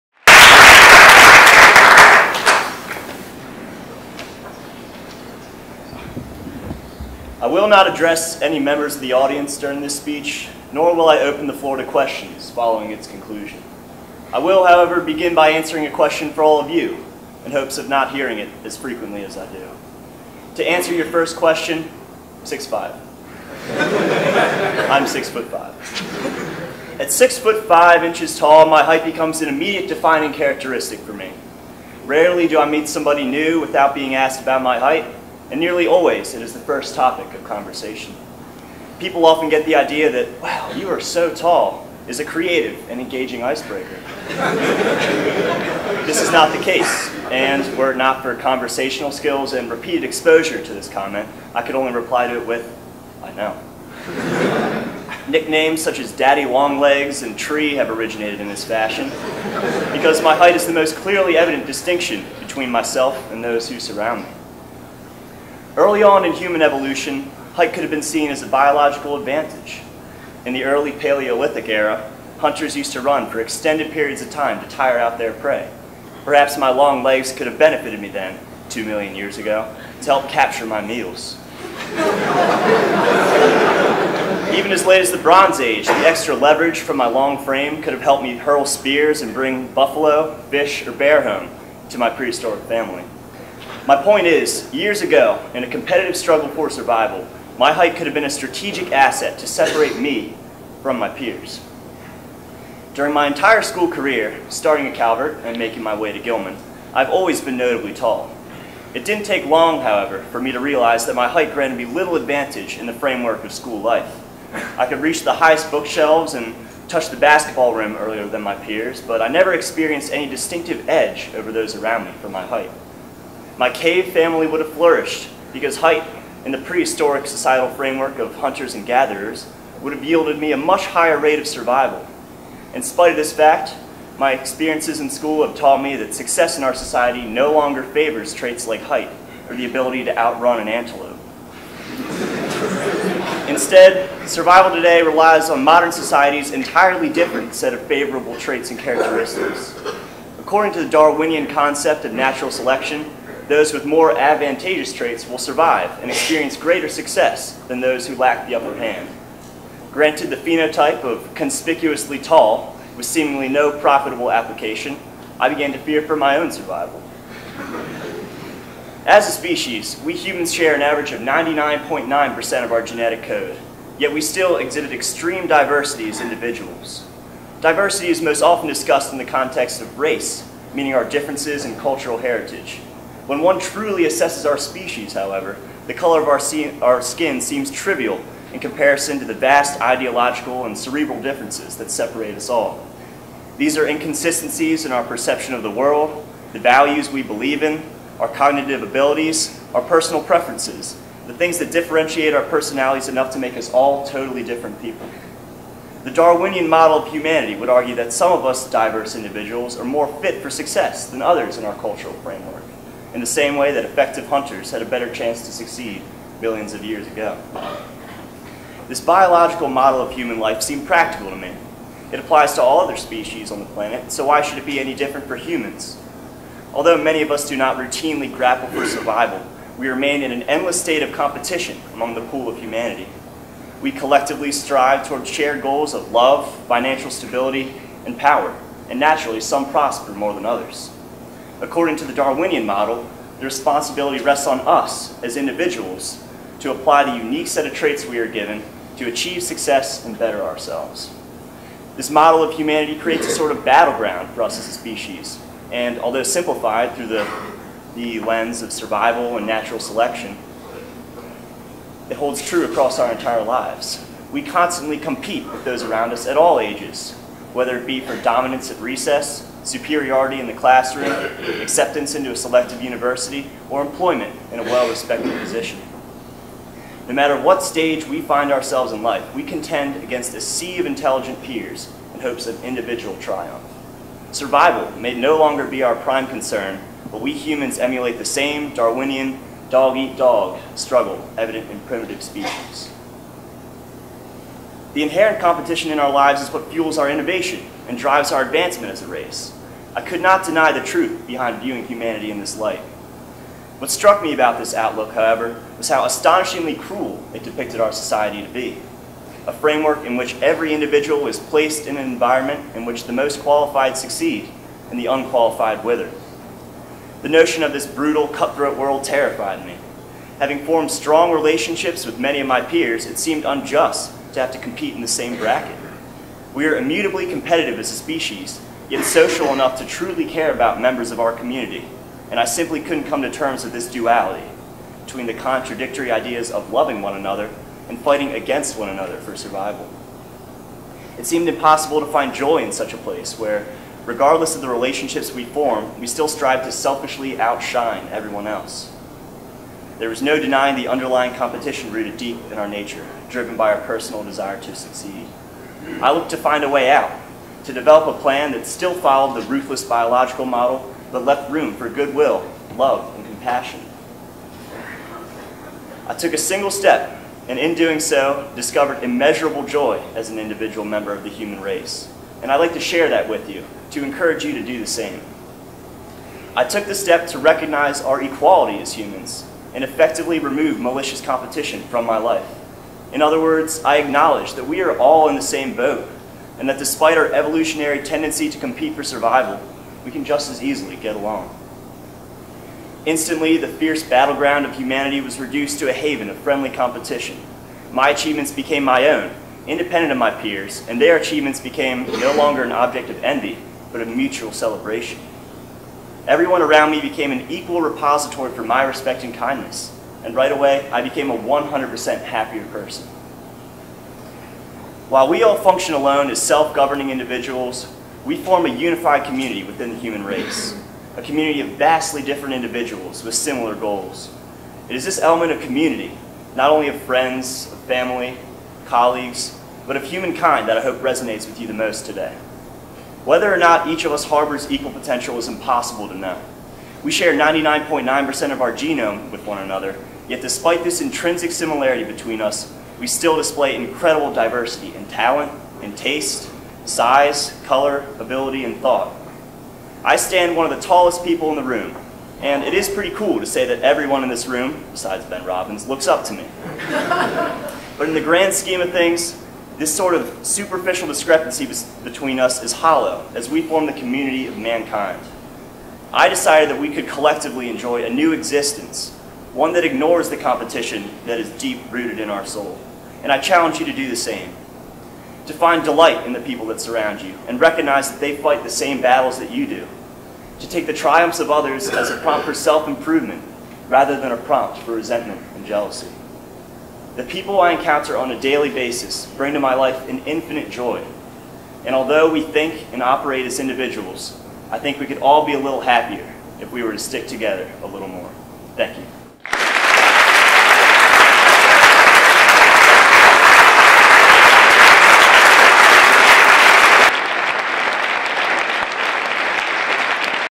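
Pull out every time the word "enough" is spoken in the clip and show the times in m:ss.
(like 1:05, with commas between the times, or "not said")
3:23, 5:29.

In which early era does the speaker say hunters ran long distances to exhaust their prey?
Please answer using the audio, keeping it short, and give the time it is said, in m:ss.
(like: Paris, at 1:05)
Paleolithic, at 1:10.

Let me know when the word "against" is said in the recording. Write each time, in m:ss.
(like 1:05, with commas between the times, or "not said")
4:40, 5:38.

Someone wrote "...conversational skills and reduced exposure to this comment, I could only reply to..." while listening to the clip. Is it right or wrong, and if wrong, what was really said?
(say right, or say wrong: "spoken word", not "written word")
wrong: "repeated", not "reduced".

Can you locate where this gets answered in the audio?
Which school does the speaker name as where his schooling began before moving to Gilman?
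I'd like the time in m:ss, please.
1:44.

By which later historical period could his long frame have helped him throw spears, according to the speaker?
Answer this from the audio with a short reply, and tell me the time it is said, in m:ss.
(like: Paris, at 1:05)
Bronze Age, at 1:25.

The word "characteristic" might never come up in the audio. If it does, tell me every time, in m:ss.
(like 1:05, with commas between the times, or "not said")
0:30, 2:28.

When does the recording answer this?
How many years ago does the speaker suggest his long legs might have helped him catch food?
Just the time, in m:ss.
1:18.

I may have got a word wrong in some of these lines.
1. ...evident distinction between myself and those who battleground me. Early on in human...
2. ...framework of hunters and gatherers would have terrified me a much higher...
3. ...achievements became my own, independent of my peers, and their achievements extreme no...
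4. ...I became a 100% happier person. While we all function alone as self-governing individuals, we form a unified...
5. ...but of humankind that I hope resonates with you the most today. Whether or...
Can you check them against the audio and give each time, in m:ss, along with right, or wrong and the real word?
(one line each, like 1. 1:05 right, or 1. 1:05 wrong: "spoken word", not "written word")
1. 1:01 wrong: "surround", not "battleground"
2. 2:07 wrong: "yielded", not "terrified"
3. 6:38 wrong: "became", not "extreme"
4. 6:50 right
5. 7:09 right.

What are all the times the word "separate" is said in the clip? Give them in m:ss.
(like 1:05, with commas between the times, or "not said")
1:39, 3:11.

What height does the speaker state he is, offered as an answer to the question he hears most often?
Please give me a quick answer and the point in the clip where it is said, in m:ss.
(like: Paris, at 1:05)
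6'5", at 0:22.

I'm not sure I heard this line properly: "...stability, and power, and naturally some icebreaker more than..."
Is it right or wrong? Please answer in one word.
wrong.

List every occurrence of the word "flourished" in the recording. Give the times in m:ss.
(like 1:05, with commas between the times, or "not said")
2:04.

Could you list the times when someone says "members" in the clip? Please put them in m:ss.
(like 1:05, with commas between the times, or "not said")
0:08, 5:30, 6:10.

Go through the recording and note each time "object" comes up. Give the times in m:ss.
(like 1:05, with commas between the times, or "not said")
6:42.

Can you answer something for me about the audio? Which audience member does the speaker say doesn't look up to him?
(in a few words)
Ben Robbins.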